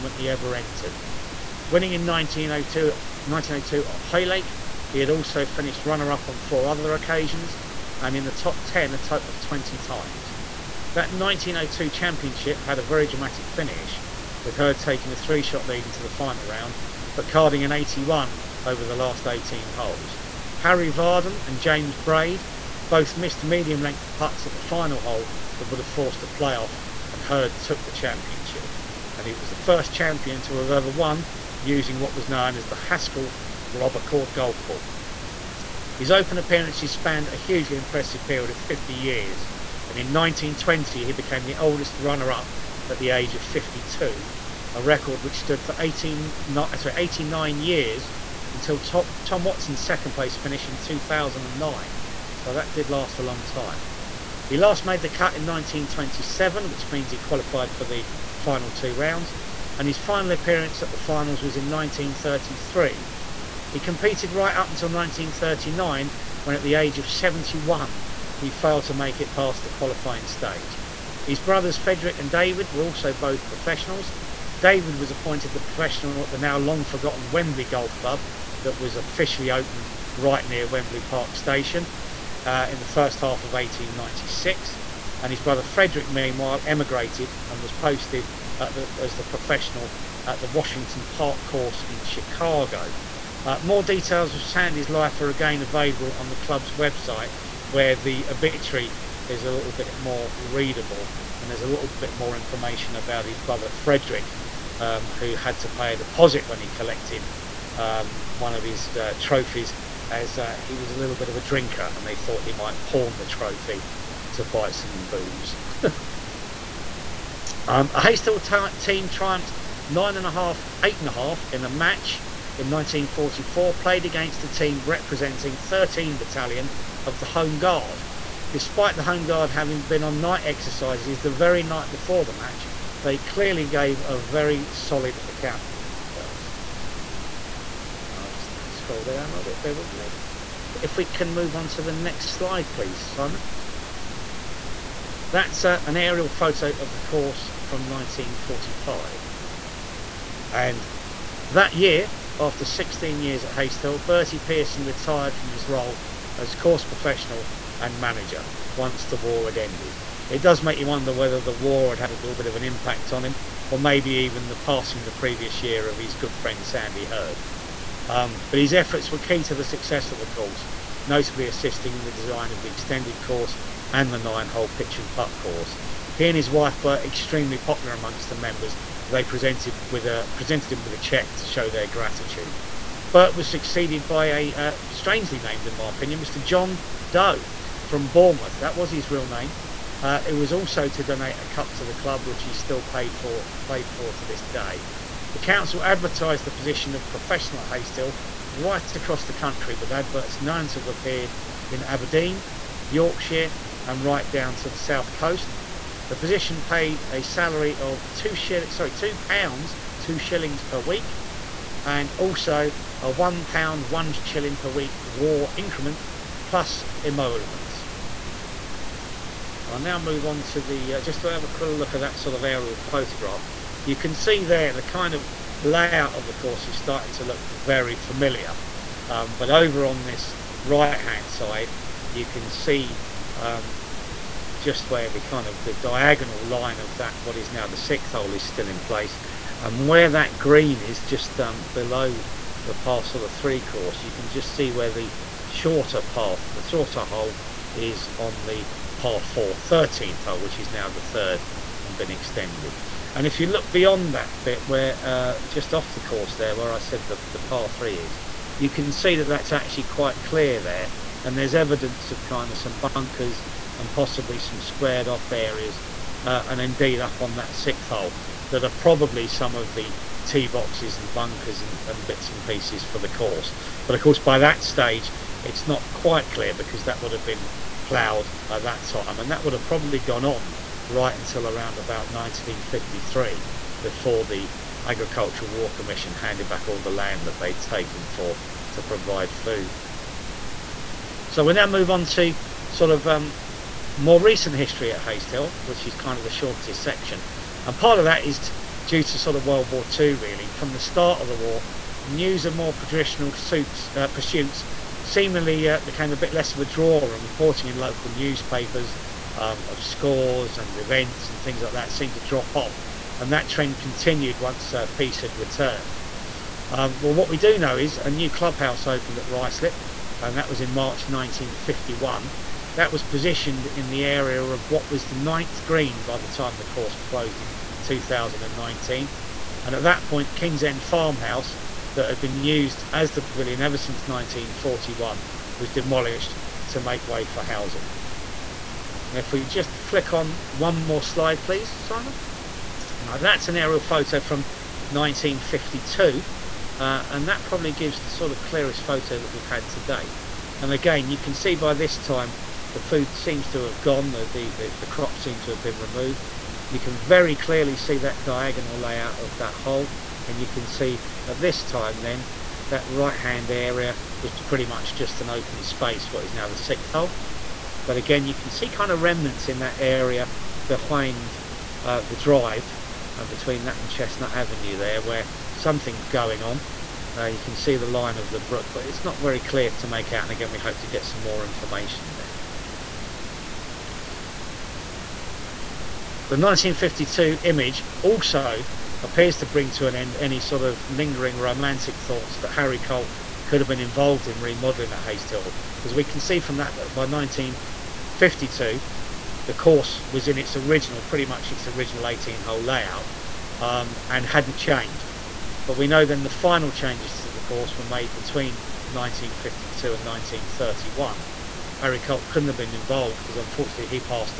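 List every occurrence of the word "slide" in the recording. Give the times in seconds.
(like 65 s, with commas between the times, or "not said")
142 s, 341 s.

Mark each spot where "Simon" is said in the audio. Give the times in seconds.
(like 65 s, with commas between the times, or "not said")
143 s, 341 s.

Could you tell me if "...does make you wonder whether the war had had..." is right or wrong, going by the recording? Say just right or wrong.
right.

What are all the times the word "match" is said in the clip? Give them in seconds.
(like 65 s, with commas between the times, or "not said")
121 s, 132 s.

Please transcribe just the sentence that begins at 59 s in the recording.
And his final appearance at the finals was in 1933.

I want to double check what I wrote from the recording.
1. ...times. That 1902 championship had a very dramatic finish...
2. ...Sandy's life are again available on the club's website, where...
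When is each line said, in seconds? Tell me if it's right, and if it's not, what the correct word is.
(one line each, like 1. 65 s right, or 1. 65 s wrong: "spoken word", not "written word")
1. 9 s right
2. 94 s right.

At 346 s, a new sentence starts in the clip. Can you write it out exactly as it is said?
Uh, and that probably gives the sort of clearest photo that we've had to date.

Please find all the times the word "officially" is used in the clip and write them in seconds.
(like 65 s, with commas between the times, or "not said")
78 s.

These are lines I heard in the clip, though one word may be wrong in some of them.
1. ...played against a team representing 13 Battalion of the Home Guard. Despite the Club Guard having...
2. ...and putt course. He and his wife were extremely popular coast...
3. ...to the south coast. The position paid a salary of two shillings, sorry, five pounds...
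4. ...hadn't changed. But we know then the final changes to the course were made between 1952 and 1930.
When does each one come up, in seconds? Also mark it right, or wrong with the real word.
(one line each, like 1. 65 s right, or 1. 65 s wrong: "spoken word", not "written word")
1. 123 s wrong: "Home", not "Club"
2. 174 s wrong: "amongst", not "coast"
3. 204 s wrong: "two", not "five"
4. 404 s wrong: "1931", not "1930".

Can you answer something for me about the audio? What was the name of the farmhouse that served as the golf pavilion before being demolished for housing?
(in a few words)
King's End Farmhouse.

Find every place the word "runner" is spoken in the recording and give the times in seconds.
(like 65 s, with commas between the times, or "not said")
5 s, 41 s.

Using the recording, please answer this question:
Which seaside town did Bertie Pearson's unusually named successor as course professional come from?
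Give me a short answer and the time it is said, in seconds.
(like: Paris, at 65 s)
Bournemouth, at 188 s.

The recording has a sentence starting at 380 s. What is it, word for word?
And again, we hope to get some more information there.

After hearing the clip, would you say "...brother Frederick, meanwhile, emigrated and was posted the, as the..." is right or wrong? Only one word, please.
right.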